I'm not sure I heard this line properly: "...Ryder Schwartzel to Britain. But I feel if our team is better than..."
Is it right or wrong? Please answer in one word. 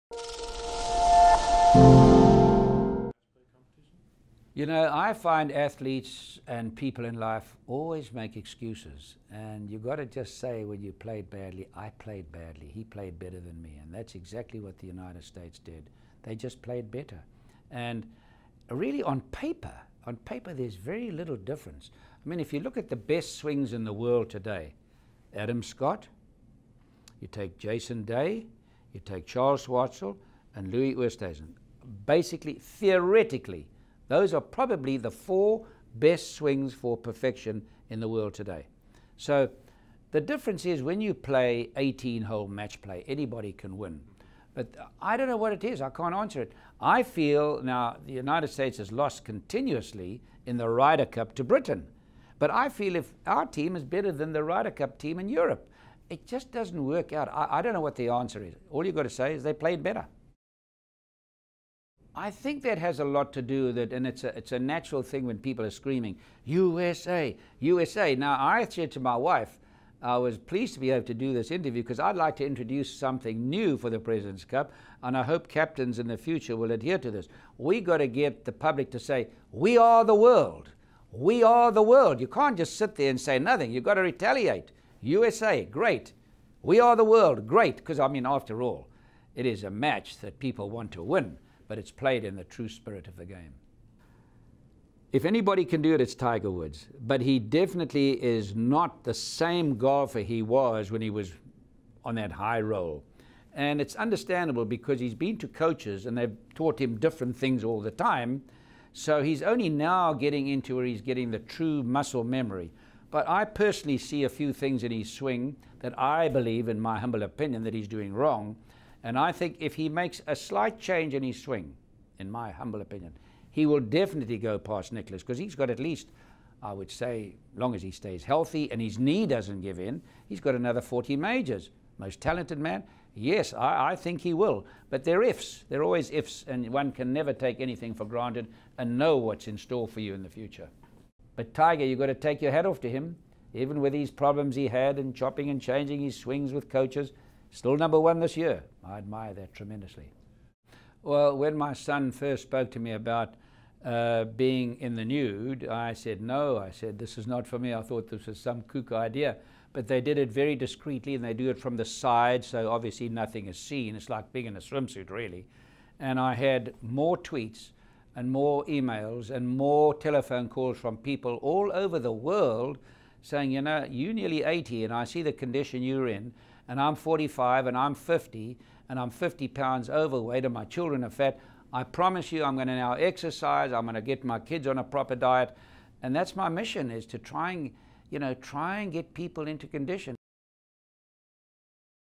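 wrong.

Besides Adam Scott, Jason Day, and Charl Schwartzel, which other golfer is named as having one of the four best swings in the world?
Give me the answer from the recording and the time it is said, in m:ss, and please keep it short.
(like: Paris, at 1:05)
Louis Oosthuizen, at 0:30.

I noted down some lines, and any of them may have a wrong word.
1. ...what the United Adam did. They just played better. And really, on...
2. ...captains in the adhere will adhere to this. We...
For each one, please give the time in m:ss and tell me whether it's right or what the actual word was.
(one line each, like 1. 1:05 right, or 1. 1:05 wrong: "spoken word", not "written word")
1. 0:14 wrong: "States", not "Adam"
2. 1:15 wrong: "future", not "adhere".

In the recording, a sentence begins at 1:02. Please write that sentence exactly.
I think that has a lot to do that, and it's a, it's a natural thing when people are screaming, USA, USA.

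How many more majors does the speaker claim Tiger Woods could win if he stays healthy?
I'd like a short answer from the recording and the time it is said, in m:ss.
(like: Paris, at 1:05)
40, at 2:10.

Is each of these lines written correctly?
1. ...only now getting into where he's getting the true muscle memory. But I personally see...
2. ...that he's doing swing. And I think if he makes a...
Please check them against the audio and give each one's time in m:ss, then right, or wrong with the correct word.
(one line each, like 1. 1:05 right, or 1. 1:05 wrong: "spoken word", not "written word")
1. 1:49 right
2. 1:57 wrong: "wrong", not "swing".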